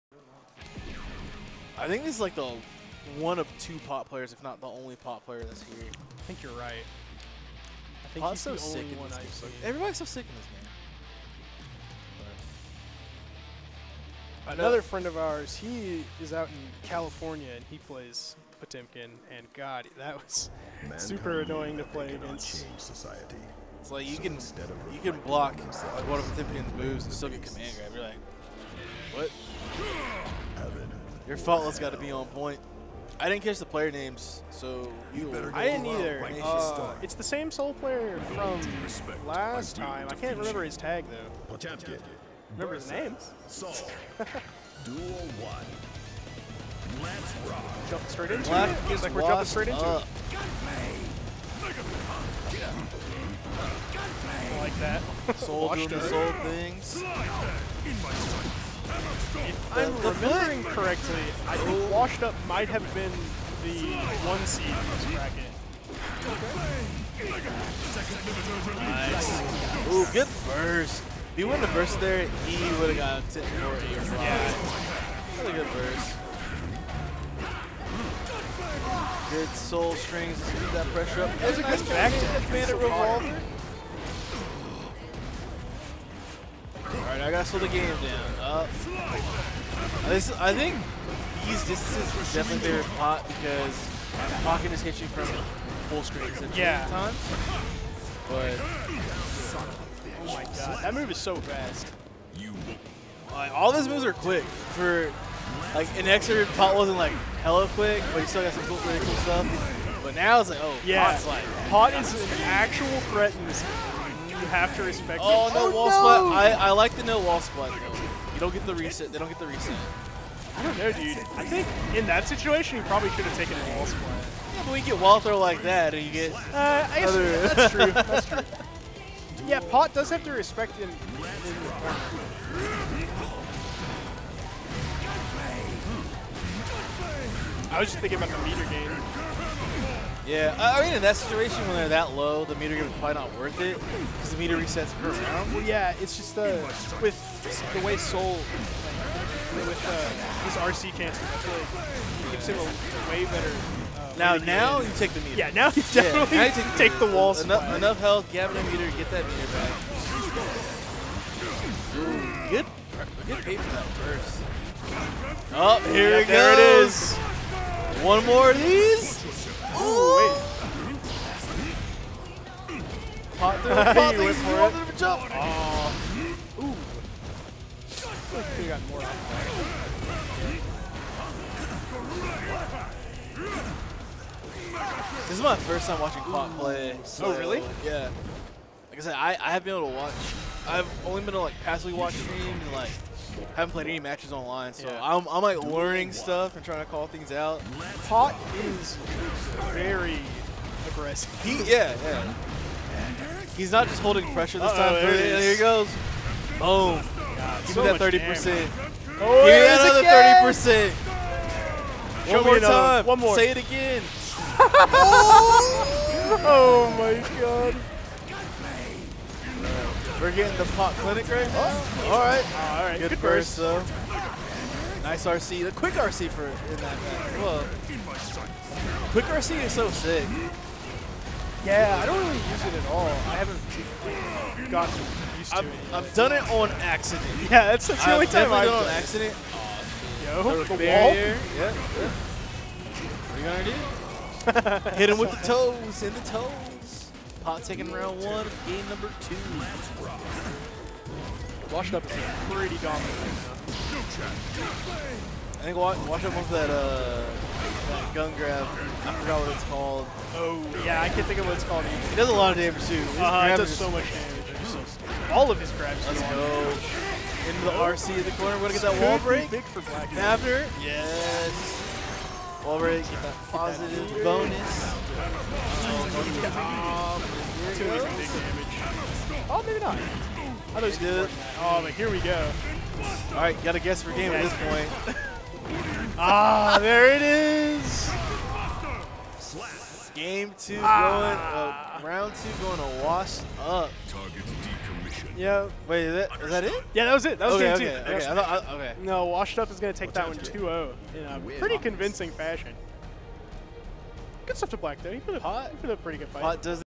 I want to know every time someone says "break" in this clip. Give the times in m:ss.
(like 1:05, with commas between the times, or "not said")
4:29.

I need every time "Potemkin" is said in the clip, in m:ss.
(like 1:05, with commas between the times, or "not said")
0:18, 0:26, 0:41.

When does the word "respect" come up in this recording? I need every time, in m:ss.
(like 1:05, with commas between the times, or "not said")
1:54, 2:10.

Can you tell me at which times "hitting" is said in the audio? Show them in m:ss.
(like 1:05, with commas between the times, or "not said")
1:34.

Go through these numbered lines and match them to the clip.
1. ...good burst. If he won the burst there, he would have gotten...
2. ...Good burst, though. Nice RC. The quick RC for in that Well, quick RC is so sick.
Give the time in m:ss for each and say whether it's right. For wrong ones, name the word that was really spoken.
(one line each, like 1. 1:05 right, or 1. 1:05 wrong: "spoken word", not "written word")
1. 1:10 right
2. 3:43 right.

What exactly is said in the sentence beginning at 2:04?
Yeah, but we get wall throw like that, and you get...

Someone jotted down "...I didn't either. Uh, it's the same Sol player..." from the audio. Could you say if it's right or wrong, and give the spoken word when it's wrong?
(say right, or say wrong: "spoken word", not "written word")
right.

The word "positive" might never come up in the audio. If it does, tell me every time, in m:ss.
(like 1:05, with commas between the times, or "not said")
4:33.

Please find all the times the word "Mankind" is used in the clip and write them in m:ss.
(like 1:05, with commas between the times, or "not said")
0:20.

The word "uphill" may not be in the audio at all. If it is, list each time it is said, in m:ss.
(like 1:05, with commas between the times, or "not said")
not said.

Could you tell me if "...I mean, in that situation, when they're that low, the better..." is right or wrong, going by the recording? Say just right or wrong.
wrong.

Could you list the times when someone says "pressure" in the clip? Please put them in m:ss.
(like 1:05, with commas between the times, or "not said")
1:20, 3:24.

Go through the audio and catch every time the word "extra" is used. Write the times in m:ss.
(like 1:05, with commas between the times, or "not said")
1:46.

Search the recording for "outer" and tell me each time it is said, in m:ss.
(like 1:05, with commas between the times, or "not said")
not said.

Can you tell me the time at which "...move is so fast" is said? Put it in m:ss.
1:40.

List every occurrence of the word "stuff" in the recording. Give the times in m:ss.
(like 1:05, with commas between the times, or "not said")
1:49, 3:16, 5:04.